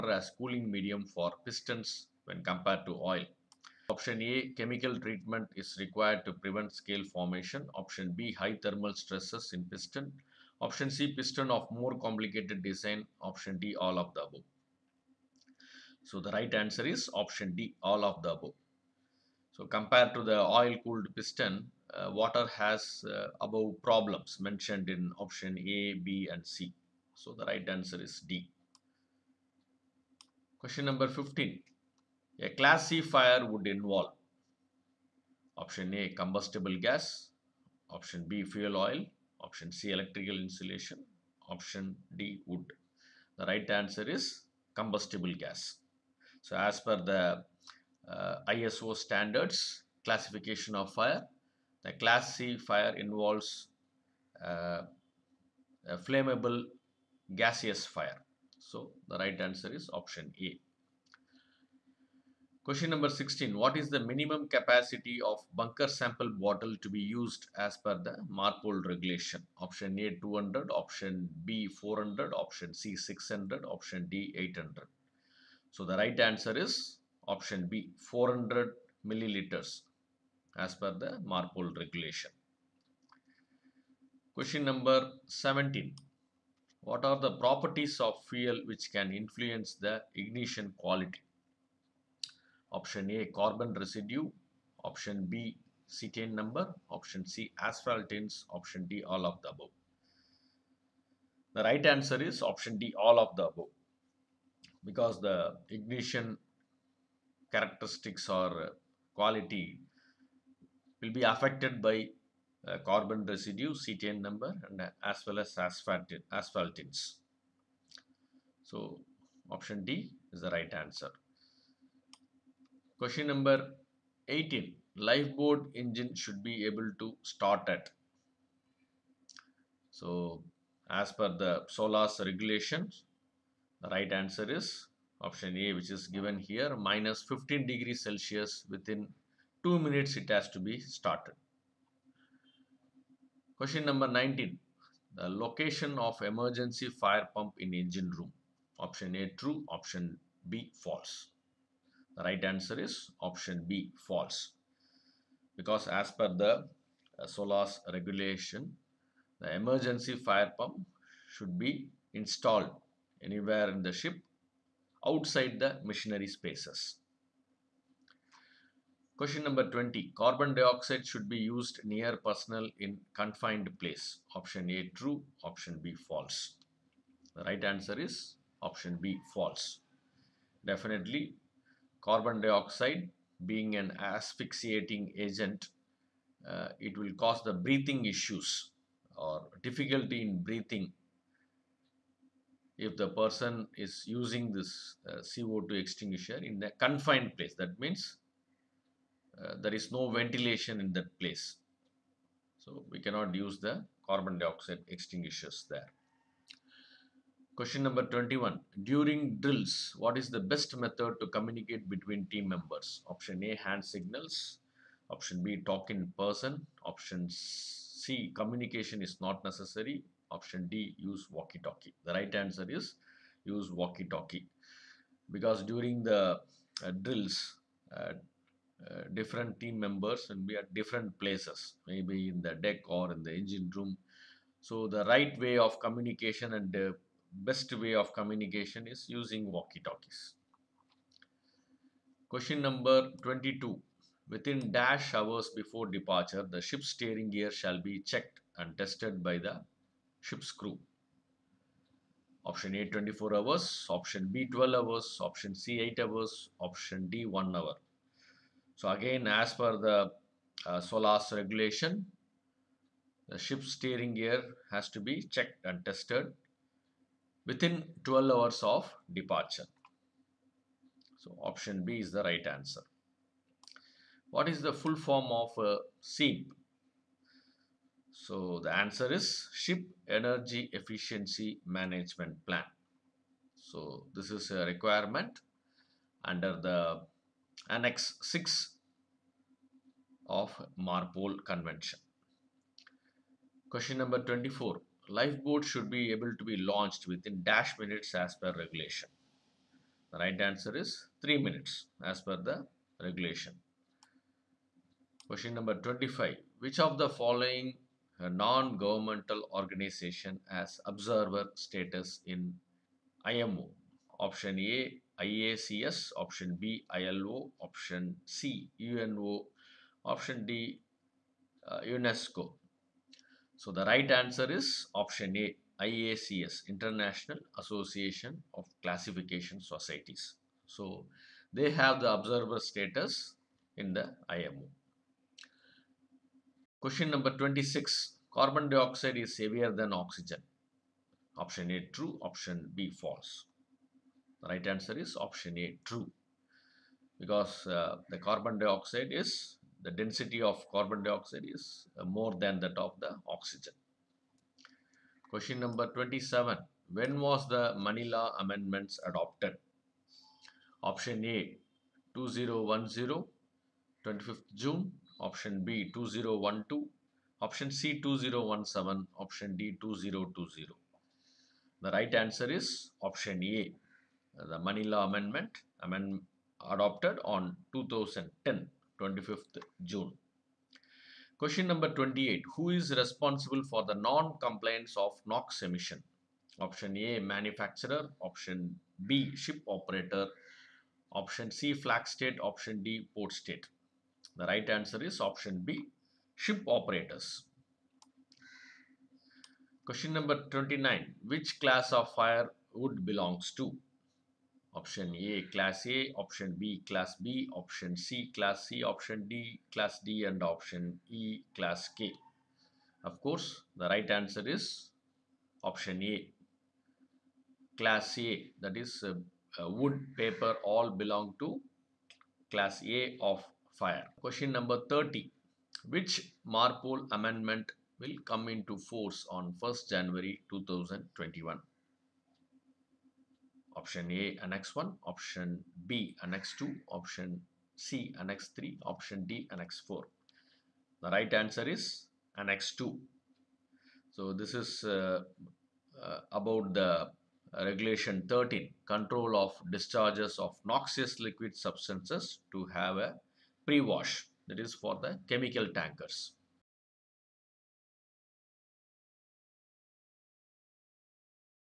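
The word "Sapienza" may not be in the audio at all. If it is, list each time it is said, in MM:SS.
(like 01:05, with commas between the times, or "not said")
not said.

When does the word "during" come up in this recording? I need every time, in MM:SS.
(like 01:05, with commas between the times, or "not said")
03:28, 03:45.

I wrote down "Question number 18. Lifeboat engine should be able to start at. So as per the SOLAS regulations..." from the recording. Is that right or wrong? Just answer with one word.
right.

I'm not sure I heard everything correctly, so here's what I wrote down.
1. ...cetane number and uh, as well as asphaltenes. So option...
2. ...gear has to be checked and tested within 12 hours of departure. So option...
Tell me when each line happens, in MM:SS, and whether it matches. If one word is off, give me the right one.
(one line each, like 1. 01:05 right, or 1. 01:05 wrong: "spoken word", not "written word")
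1. 01:53 right
2. 04:24 right.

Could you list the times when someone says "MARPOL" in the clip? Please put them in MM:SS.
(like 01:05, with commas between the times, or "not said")
01:08, 01:21, 04:50, 07:06.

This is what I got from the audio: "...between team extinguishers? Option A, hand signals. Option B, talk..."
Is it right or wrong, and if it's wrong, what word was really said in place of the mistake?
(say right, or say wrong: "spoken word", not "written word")
wrong: "members", not "extinguishers".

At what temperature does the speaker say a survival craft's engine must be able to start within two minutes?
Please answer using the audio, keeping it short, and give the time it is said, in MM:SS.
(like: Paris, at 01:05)
-15 degrees Celsius, at 02:16.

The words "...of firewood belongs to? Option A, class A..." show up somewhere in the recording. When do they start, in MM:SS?
06:41.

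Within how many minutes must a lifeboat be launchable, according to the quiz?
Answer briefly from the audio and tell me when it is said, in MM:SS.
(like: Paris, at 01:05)
3 minutes, at 05:01.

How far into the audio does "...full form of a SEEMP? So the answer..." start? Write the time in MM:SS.
04:34.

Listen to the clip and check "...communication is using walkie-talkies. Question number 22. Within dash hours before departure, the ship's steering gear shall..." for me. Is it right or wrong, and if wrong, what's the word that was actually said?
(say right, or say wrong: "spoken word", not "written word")
right.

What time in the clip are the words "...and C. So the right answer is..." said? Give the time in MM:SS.
00:26.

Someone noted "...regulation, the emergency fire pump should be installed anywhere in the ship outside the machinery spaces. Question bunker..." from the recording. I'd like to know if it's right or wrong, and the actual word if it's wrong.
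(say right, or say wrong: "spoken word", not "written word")
wrong: "number", not "bunker".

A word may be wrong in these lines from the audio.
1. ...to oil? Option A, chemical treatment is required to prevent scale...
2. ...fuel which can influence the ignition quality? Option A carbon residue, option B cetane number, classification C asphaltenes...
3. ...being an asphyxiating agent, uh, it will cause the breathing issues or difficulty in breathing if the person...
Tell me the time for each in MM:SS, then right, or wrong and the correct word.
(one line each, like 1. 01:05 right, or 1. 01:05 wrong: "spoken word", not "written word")
1. 00:02 right
2. 01:28 wrong: "option", not "classification"
3. 03:03 right.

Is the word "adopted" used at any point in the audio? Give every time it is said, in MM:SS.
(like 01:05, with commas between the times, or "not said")
05:59, 06:16.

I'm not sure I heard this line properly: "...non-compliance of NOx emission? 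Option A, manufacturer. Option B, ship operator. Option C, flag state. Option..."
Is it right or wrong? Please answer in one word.
right.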